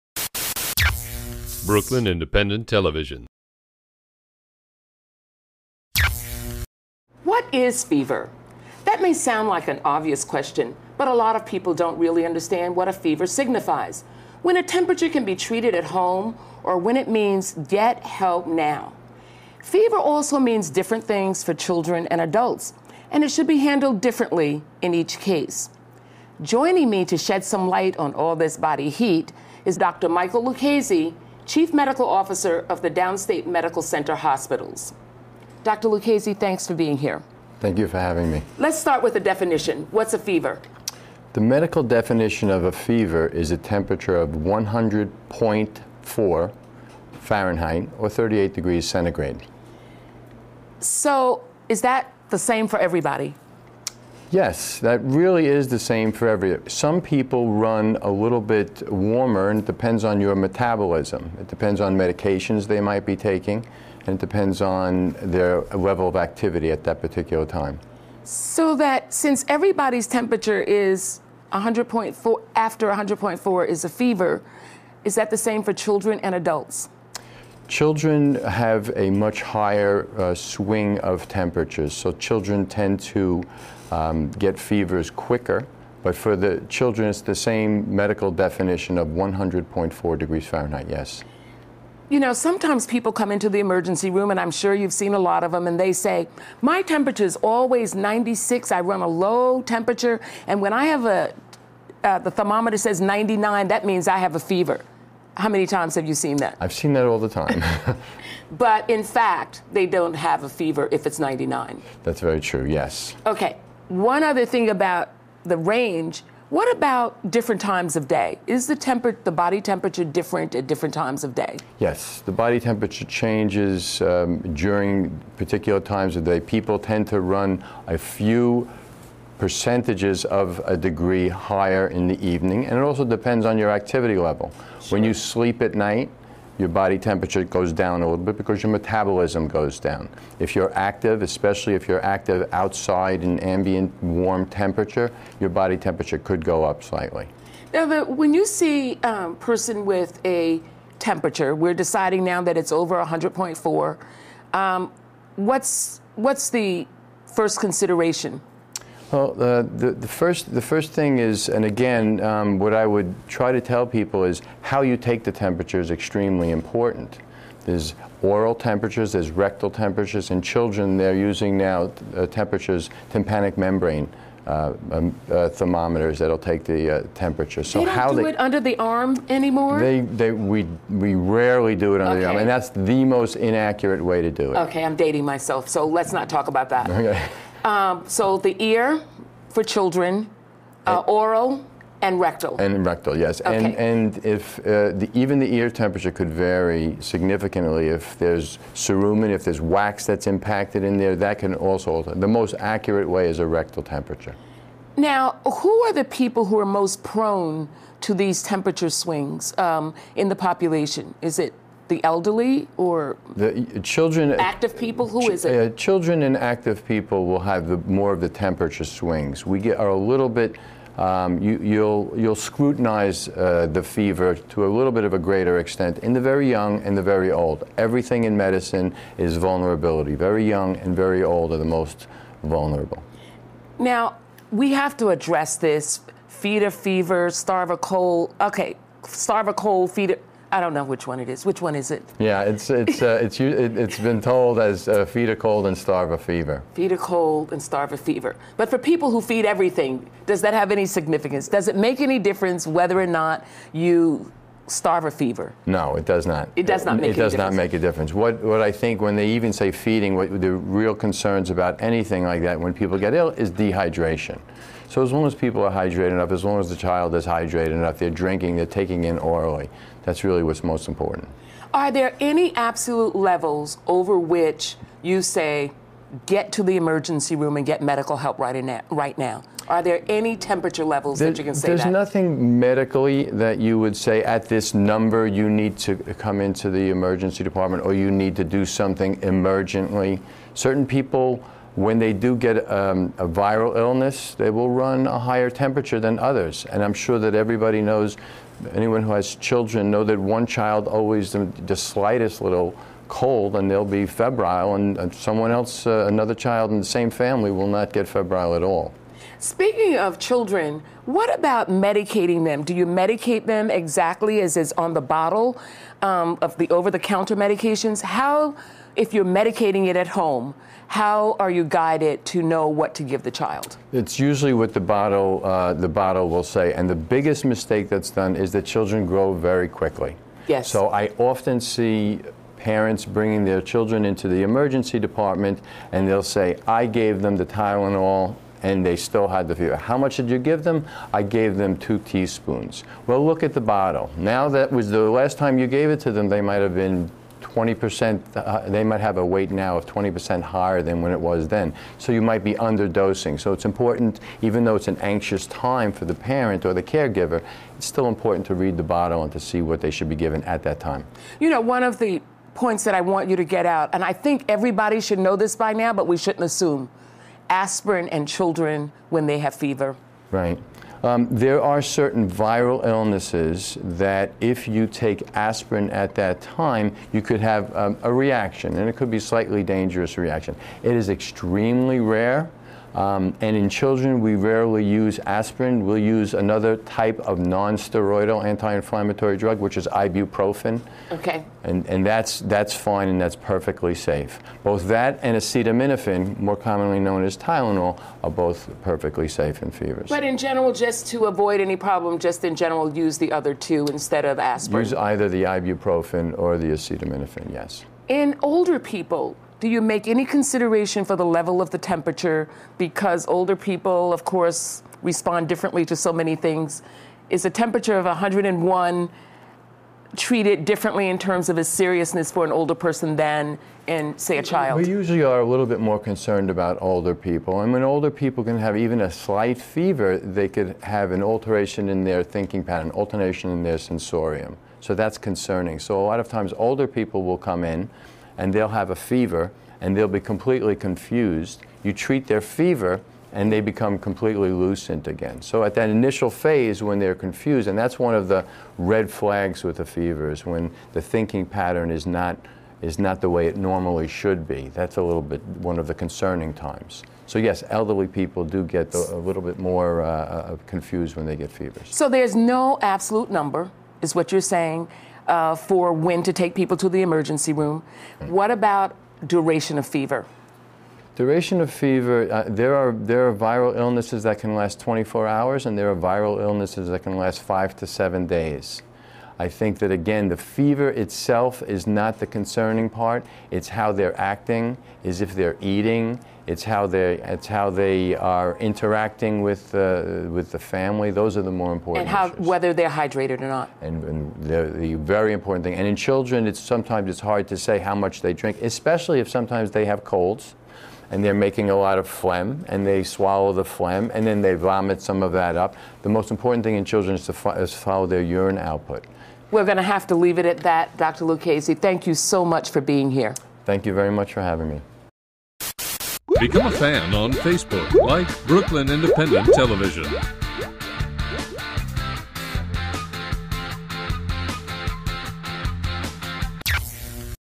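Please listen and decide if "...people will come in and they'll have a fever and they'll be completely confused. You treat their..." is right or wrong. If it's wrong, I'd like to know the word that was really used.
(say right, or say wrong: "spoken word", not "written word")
right.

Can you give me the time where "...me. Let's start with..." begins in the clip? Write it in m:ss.
0:38.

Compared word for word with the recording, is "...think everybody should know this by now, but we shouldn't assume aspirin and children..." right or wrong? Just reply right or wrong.
right.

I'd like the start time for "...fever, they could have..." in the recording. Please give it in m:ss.
7:09.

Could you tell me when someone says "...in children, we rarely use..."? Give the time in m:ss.
6:23.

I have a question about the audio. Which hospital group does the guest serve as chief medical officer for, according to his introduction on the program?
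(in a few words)
Downstate Medical Center.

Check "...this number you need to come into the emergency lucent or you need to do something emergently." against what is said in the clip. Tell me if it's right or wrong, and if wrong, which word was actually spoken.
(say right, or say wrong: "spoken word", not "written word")
wrong: "department", not "lucent".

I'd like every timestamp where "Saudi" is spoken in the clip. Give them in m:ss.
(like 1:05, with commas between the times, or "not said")
not said.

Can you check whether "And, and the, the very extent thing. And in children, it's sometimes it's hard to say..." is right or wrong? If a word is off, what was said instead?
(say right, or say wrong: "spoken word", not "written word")
wrong: "important", not "extent".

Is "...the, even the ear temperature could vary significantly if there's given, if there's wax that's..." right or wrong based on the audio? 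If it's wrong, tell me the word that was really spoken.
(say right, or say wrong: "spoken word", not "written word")
wrong: "cerumen", not "given".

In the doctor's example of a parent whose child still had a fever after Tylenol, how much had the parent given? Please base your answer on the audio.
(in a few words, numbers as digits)
two teaspoons.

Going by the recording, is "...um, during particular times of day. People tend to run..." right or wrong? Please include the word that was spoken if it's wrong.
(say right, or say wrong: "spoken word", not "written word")
right.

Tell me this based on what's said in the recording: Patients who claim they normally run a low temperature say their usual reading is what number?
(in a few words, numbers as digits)
96.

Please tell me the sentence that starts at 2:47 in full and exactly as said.
There's oral temperatures, there's rectal temperatures.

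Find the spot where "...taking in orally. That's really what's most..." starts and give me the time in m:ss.
4:28.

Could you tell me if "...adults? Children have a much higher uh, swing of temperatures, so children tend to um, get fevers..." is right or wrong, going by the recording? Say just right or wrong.
right.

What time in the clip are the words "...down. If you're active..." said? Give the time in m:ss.
2:19.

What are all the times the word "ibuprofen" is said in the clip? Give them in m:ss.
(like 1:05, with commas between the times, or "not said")
6:29, 6:45.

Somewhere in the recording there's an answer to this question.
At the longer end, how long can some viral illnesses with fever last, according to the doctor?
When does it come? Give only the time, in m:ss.
7:57.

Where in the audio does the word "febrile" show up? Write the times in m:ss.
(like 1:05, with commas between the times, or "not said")
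5:04, 5:08.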